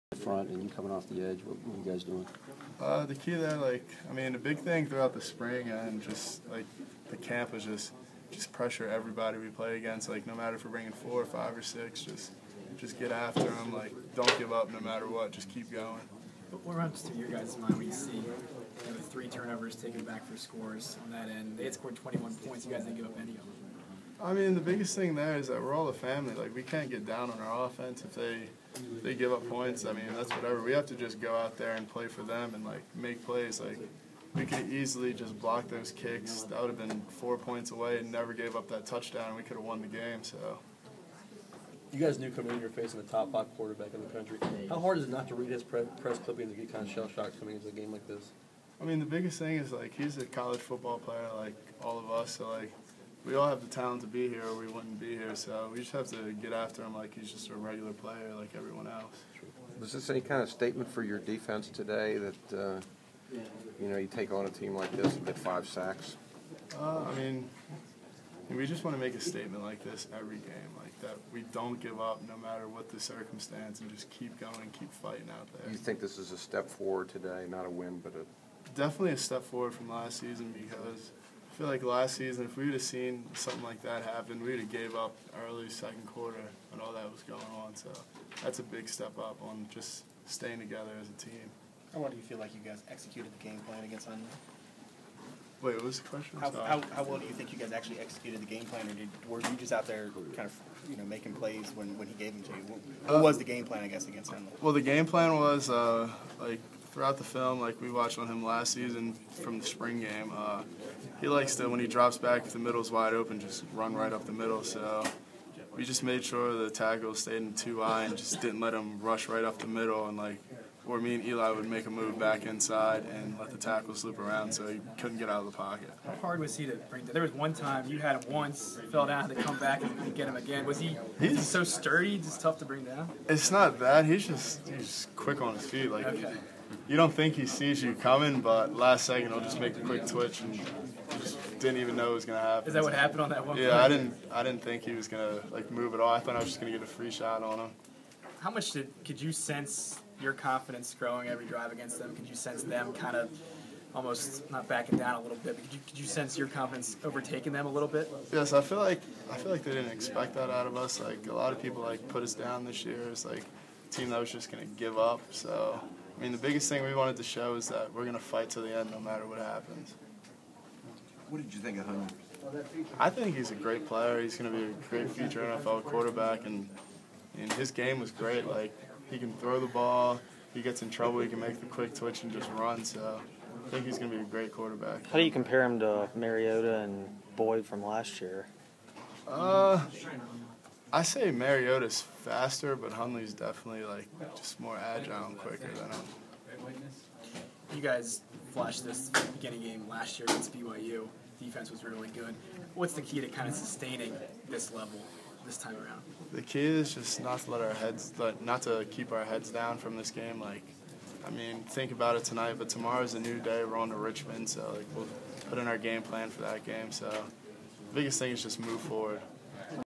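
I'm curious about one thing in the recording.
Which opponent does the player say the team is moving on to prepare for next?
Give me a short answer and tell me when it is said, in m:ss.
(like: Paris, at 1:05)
Richmond, at 3:33.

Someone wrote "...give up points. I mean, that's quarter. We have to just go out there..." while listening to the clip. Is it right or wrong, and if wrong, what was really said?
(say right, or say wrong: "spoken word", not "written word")
wrong: "whatever", not "quarter".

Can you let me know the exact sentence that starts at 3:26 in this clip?
The key is just not to let our heads, not to keep our heads down from this game.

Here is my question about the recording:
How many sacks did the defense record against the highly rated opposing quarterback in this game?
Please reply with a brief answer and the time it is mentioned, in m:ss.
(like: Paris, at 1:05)
5, at 1:05.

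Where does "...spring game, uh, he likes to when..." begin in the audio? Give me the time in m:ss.
1:49.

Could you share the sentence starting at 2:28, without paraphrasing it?
How much did could you sense your confidence growing every drive against them?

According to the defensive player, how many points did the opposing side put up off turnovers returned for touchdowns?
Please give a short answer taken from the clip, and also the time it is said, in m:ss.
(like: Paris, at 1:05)
21, at 0:21.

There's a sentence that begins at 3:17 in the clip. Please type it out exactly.
You guys flashed this beginning game last year against BYU.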